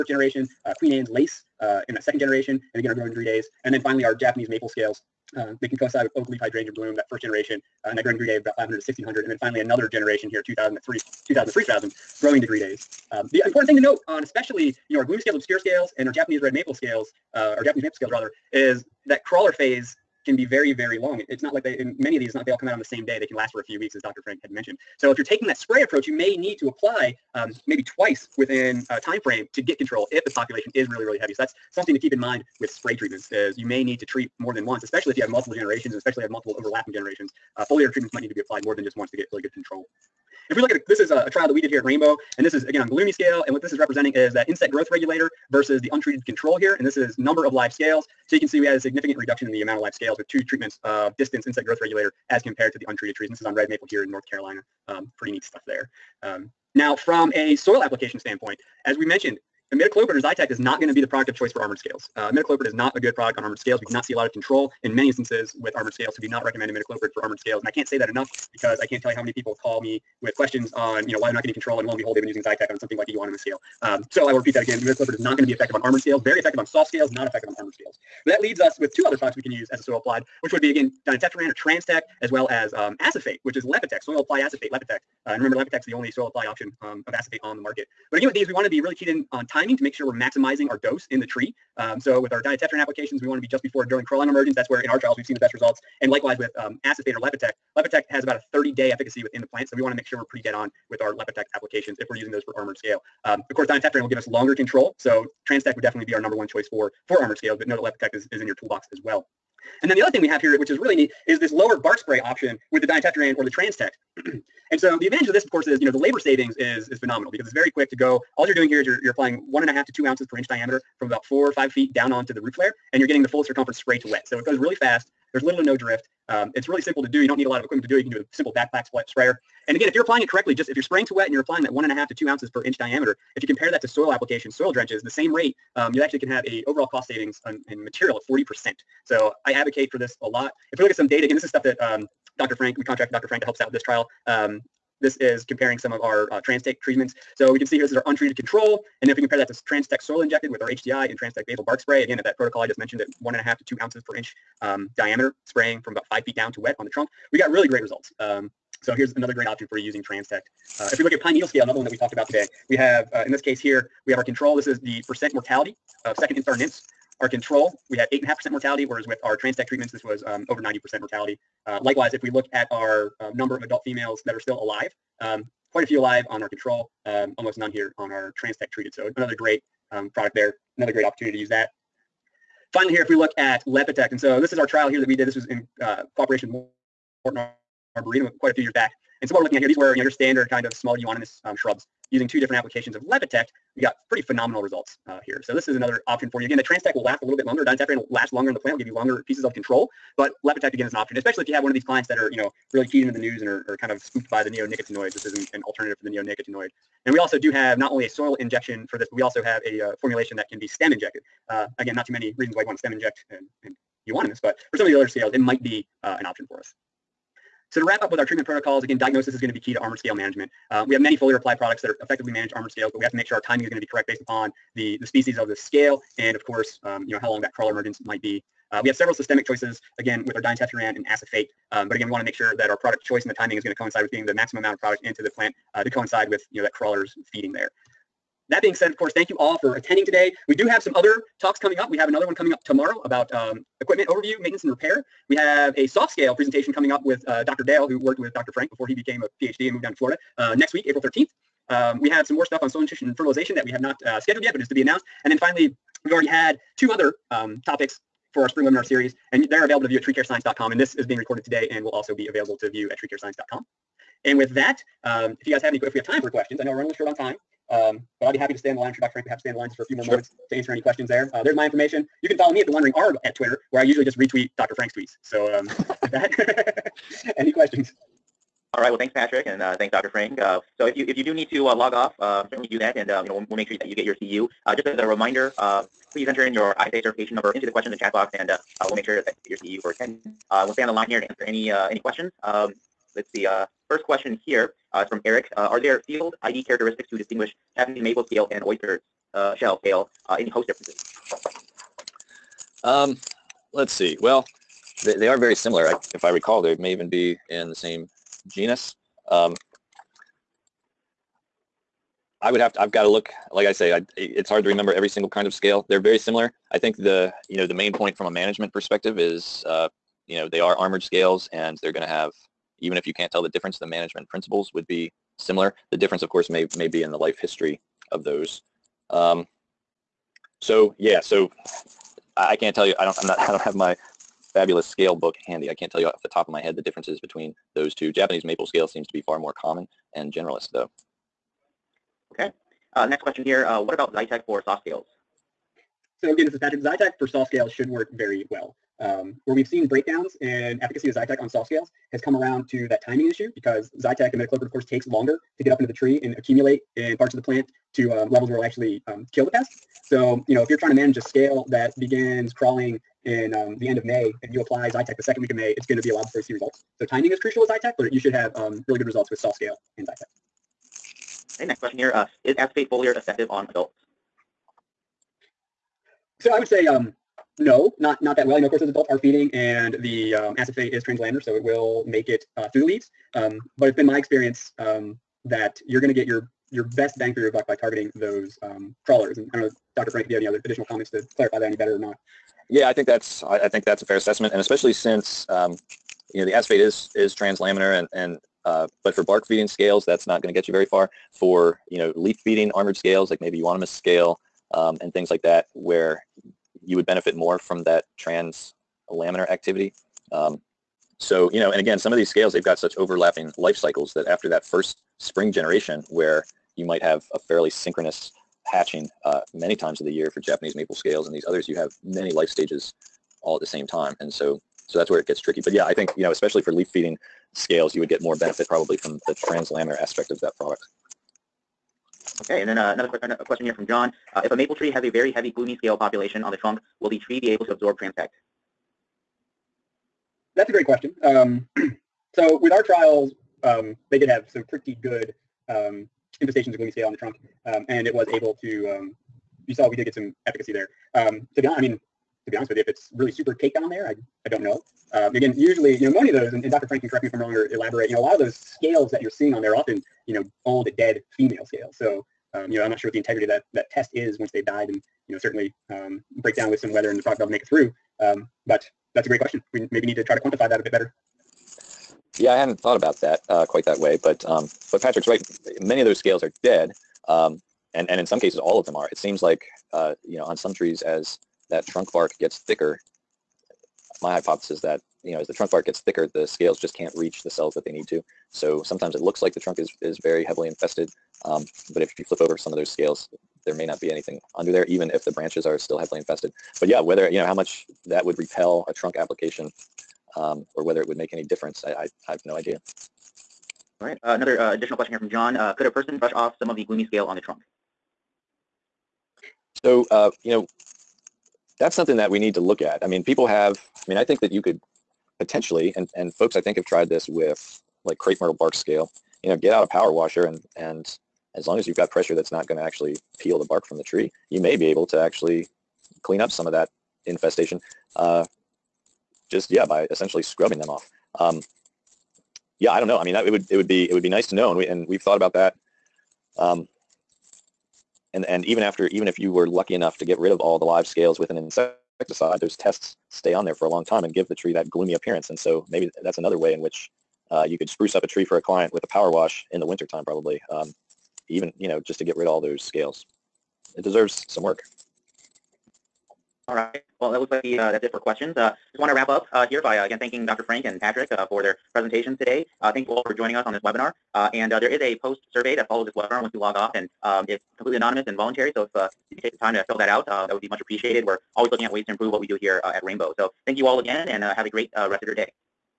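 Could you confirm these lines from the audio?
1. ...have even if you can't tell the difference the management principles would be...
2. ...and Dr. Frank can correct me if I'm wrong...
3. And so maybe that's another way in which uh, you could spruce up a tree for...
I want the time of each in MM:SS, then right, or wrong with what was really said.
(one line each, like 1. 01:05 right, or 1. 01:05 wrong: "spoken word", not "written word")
1. 05:22 right
2. 07:36 right
3. 09:05 right.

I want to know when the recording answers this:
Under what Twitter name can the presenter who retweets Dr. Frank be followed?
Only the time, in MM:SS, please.
04:32.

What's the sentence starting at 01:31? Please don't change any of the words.
Um, so with our dinotefuran applications, we want to be just before drilling crawling emergence.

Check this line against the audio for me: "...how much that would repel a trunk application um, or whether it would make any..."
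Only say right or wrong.
right.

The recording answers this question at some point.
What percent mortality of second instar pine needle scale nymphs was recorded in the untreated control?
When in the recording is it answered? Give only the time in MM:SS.
02:48.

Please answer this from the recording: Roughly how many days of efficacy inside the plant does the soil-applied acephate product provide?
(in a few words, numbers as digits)
30.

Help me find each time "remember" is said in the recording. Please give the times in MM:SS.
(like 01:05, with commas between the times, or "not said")
01:25, 05:14.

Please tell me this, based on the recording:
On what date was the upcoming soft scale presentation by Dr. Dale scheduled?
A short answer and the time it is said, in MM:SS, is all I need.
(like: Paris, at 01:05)
April 13th, at 04:10.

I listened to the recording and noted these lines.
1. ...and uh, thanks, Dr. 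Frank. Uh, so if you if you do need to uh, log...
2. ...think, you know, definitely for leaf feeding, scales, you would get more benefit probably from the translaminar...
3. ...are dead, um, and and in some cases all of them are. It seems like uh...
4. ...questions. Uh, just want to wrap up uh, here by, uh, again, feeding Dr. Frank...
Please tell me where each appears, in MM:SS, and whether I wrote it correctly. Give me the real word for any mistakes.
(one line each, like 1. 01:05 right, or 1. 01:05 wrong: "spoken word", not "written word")
1. 04:39 right
2. 07:05 wrong: "especially", not "definitely"
3. 07:56 right
4. 09:18 wrong: "thanking", not "feeding".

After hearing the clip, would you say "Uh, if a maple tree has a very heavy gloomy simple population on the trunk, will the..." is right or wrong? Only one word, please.
wrong.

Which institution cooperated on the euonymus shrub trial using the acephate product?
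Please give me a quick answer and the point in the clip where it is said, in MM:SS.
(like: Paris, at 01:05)
Morton Arboretum, at 03:07.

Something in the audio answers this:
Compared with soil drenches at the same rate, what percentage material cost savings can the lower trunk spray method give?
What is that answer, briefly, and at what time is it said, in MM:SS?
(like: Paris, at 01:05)
40%, at 02:18.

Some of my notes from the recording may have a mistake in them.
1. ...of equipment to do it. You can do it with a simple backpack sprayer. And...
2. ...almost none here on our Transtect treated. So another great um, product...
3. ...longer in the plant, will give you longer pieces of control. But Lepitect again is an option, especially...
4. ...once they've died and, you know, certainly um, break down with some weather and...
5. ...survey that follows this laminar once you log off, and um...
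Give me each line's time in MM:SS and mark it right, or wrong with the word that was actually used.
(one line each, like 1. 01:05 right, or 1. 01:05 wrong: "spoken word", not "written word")
1. 02:07 right
2. 02:57 right
3. 03:18 right
4. 07:44 right
5. 09:25 wrong: "webinar", not "laminar".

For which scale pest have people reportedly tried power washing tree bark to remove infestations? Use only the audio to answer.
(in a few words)
Crepe myrtle bark scale.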